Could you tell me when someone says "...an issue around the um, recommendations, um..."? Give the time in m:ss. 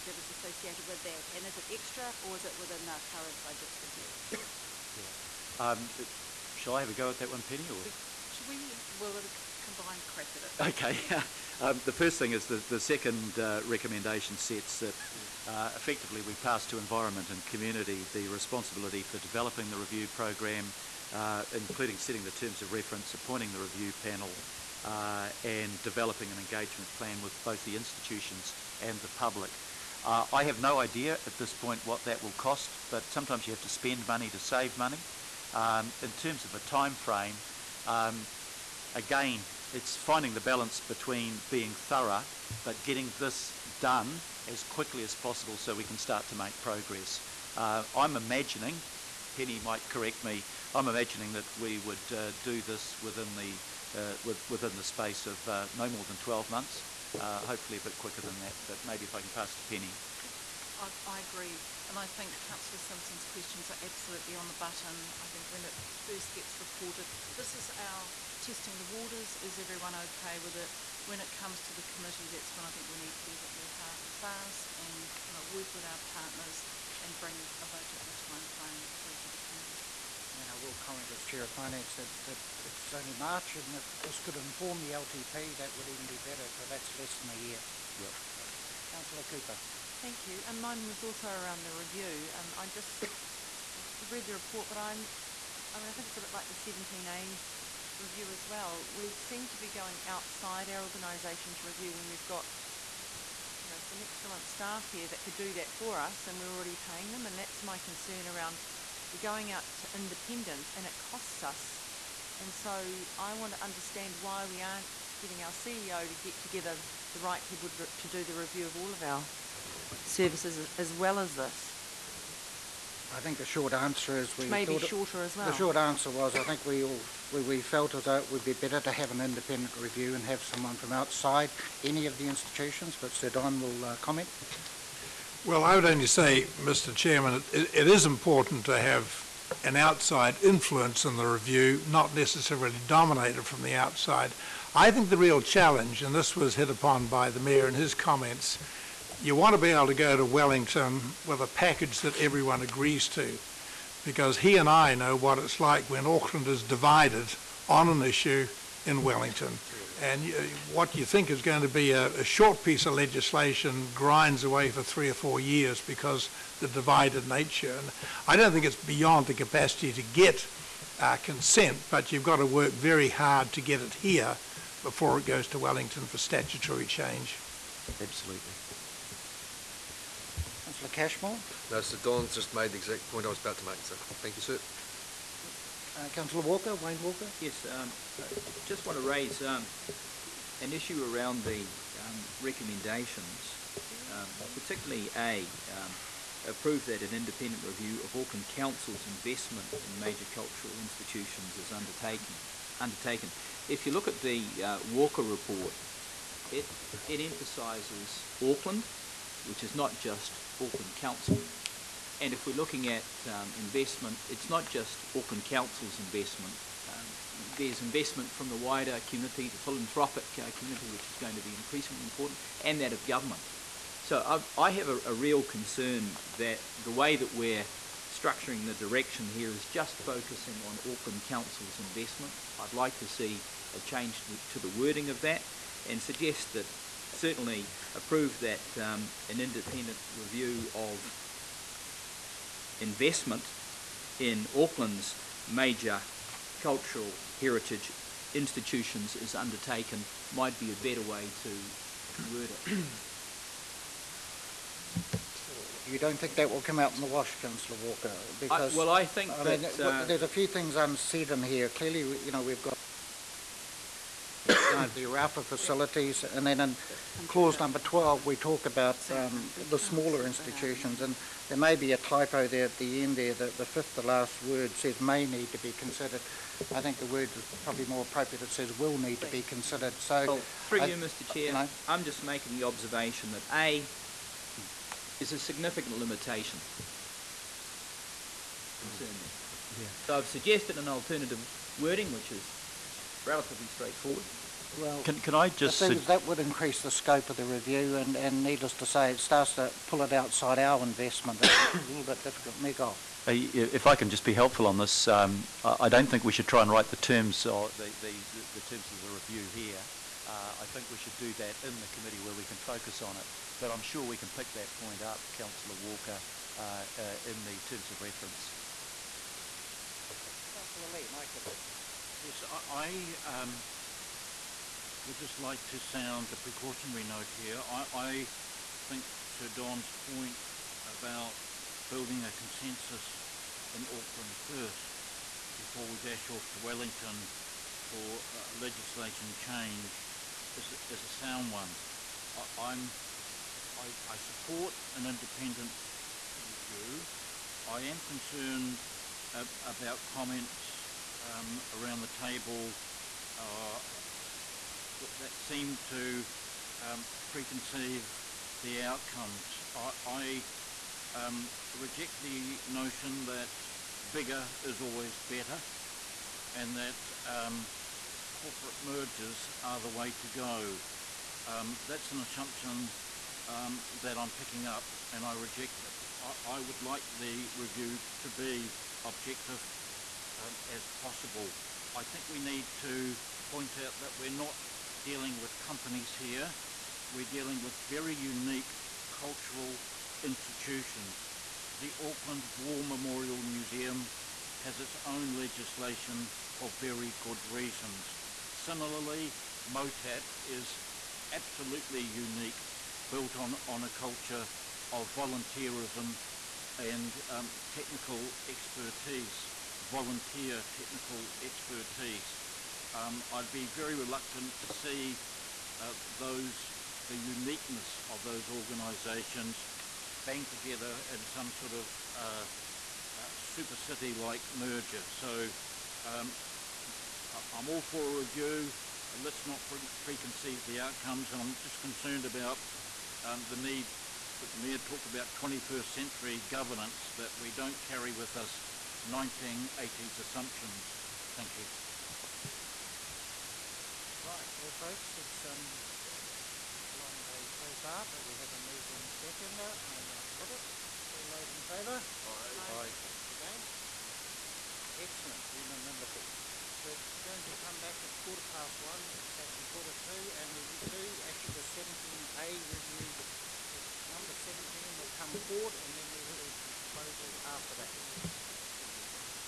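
3:10.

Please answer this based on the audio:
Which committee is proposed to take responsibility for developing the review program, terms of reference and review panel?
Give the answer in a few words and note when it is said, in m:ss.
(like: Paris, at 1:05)
environment and community, at 0:16.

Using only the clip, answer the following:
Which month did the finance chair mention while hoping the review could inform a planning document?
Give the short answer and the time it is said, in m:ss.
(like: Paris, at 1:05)
March, at 1:23.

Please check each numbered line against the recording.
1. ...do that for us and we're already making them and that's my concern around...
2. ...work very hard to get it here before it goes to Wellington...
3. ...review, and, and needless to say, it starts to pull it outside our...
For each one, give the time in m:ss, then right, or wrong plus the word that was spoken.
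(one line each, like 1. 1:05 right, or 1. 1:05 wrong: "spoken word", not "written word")
1. 1:45 wrong: "paying", not "making"
2. 2:52 right
3. 4:57 right.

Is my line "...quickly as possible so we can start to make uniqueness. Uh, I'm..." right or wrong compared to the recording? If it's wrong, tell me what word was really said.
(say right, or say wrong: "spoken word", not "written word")
wrong: "progress", not "uniqueness".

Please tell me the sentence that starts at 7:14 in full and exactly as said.
For, the Mayor talked about 21st century governance that we don't carry with us 1980s assumptions.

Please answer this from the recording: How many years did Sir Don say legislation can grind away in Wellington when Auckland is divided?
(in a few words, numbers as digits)
three or four.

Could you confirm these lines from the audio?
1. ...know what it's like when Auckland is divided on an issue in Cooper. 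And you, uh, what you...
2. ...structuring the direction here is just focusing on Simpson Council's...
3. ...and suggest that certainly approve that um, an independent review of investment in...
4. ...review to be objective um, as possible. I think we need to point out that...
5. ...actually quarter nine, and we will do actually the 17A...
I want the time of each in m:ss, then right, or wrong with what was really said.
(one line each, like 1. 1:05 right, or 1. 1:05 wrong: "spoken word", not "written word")
1. 2:34 wrong: "Wellington", not "Cooper"
2. 3:48 wrong: "Auckland", not "Simpson"
3. 3:55 right
4. 6:17 right
5. 7:39 wrong: "two", not "nine".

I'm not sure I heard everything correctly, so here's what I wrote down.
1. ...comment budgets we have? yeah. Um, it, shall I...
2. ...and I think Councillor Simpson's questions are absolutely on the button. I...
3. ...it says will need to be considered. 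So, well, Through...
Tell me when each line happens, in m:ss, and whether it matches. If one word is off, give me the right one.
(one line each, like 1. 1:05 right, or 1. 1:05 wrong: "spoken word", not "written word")
1. 0:03 wrong: "current", not "comment"
2. 1:01 right
3. 4:38 right.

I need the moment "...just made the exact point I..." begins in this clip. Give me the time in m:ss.
3:02.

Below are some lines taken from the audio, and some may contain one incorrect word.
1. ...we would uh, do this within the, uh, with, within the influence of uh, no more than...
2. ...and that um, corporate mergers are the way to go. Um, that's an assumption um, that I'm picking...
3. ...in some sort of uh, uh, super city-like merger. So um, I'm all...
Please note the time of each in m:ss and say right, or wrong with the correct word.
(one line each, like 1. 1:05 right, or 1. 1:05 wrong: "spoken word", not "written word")
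1. 0:51 wrong: "space", not "influence"
2. 6:06 right
3. 7:01 right.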